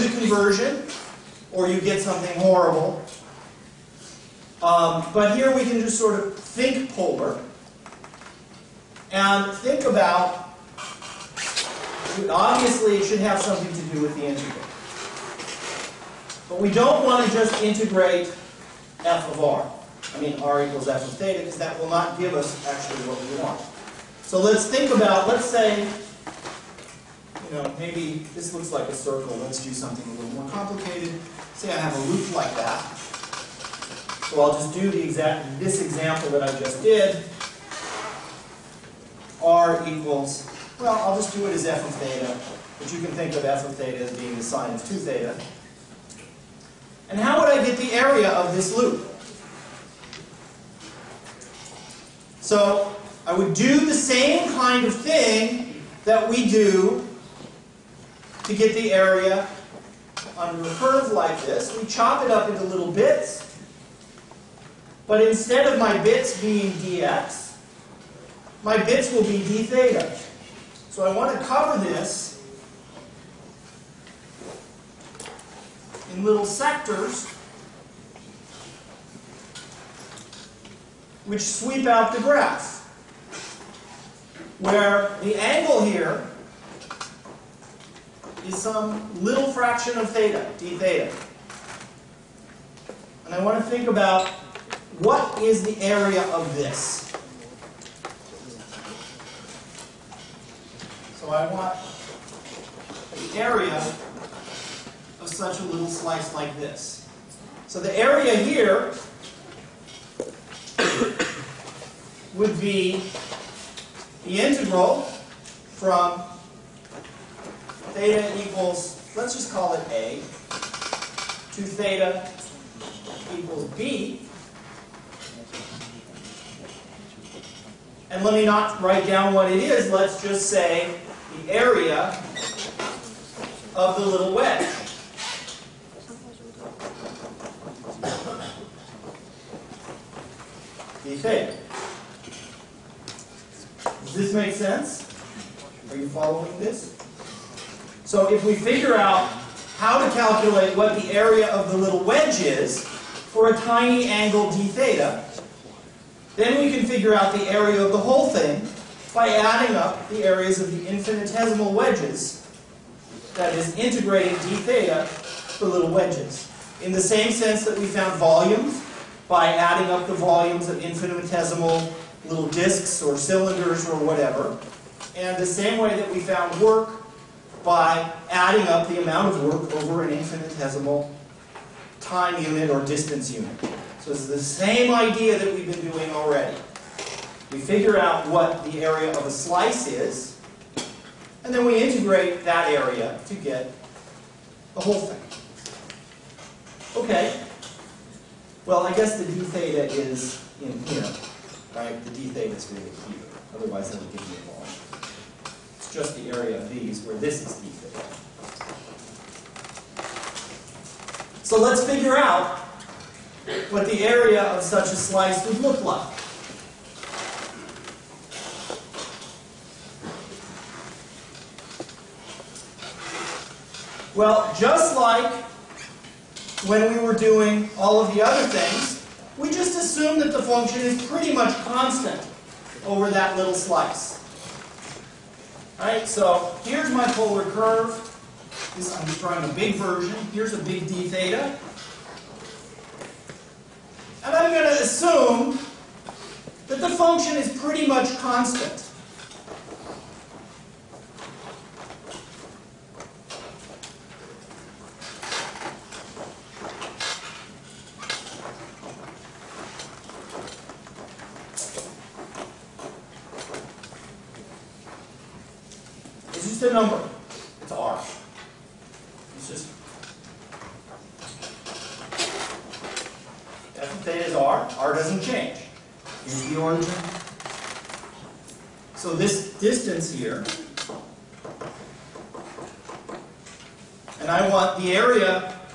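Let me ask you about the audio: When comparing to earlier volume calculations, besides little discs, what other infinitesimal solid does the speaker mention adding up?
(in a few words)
cylinders.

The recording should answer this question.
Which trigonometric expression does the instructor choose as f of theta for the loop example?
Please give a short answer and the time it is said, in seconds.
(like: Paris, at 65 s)
sine of 2 theta, at 44 s.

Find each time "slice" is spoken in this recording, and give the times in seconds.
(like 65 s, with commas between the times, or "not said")
105 s, 189 s, 214 s, 233 s.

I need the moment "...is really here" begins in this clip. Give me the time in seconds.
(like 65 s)
202 s.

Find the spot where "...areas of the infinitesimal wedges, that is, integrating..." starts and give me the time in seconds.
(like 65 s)
160 s.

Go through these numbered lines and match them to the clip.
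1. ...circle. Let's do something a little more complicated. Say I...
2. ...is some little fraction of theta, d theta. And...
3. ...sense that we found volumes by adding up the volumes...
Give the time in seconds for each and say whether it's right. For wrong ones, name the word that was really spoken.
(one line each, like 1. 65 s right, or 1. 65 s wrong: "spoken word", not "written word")
1. 28 s right
2. 88 s right
3. 167 s right.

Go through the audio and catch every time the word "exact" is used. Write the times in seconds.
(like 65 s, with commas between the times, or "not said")
35 s.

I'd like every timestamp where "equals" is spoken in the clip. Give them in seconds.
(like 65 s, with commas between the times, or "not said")
20 s, 39 s, 118 s, 123 s.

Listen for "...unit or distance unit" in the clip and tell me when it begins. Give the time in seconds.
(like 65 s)
182 s.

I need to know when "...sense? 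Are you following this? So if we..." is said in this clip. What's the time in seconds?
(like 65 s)
144 s.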